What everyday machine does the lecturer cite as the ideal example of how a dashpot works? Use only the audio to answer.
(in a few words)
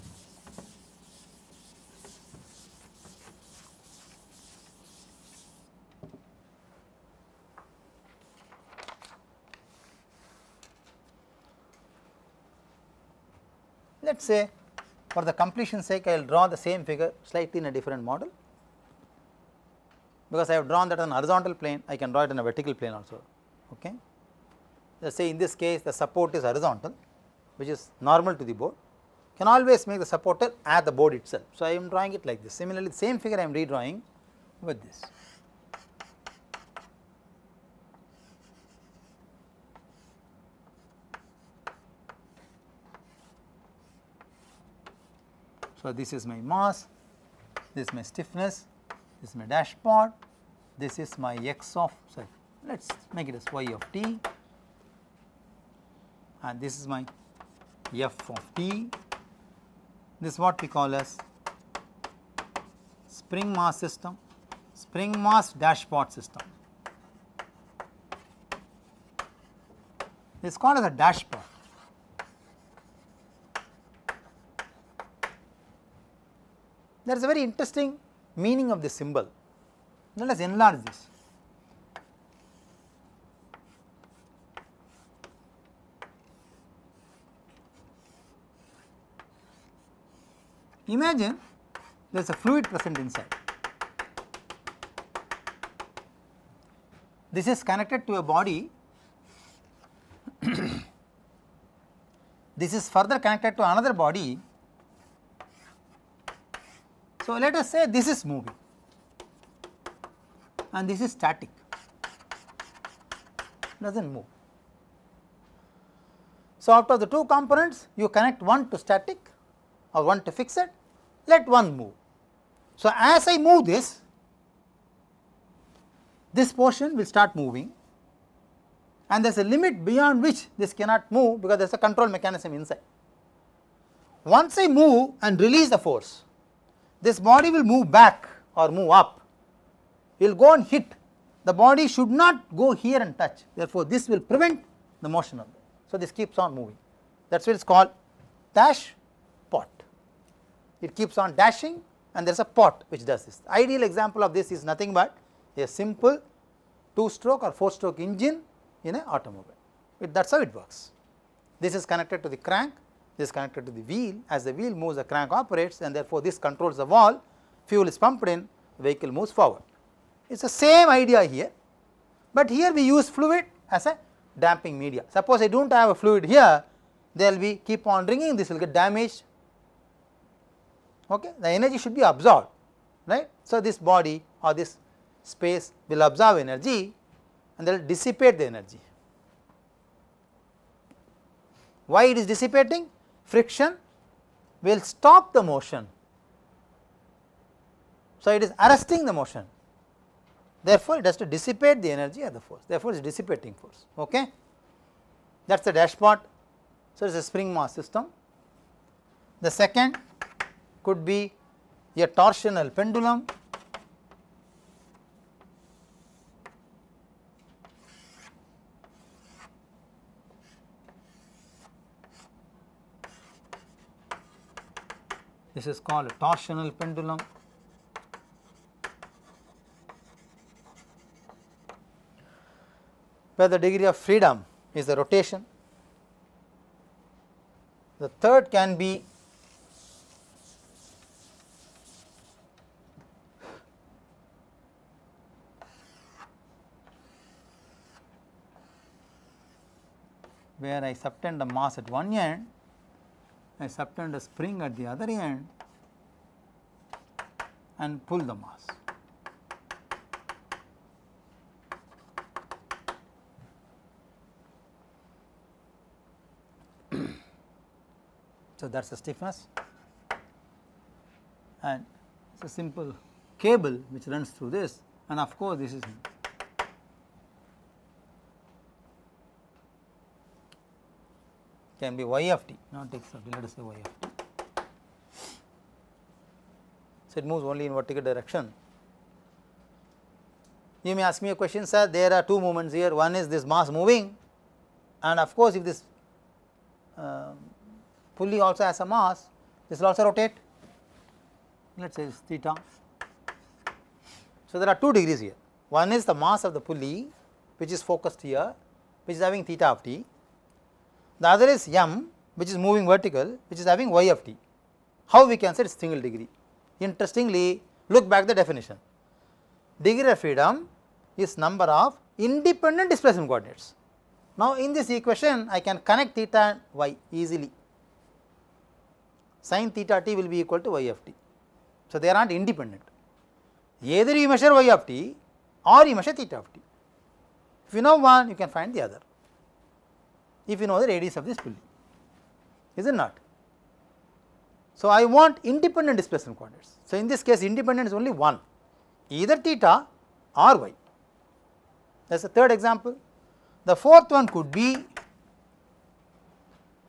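2 stroke or 4 stroke engine.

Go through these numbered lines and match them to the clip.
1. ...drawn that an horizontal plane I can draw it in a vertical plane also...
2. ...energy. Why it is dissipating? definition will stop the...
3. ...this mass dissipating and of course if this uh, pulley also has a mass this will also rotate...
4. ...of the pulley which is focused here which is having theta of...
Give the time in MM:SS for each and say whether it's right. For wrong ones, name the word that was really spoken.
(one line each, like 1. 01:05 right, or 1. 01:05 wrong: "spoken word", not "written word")
1. 00:20 right
2. 03:08 wrong: "friction", not "definition"
3. 04:53 wrong: "moving", not "dissipating"
4. 05:06 right.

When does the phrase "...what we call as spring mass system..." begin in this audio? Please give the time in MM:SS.
01:00.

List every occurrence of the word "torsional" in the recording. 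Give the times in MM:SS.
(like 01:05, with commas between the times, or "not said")
03:32, 03:46.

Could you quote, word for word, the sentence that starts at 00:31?
So, I am drawing it like this similarly the same figure I am redrawing with this.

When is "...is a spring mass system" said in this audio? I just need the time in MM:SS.
03:27.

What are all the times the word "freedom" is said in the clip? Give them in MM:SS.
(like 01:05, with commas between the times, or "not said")
03:53, 05:20.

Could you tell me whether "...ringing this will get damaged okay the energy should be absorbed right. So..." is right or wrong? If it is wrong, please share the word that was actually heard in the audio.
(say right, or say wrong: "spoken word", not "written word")
right.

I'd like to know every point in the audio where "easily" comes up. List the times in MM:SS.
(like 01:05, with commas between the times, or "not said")
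05:27.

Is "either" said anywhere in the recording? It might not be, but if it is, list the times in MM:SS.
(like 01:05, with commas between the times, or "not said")
05:33, 05:49.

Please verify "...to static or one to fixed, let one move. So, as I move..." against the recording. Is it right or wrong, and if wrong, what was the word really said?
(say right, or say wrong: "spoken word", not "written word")
right.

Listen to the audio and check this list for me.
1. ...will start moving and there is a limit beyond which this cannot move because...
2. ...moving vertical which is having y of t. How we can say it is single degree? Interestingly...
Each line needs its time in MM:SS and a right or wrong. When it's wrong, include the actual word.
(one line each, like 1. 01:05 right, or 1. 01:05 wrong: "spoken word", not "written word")
1. 02:06 right
2. 05:12 right.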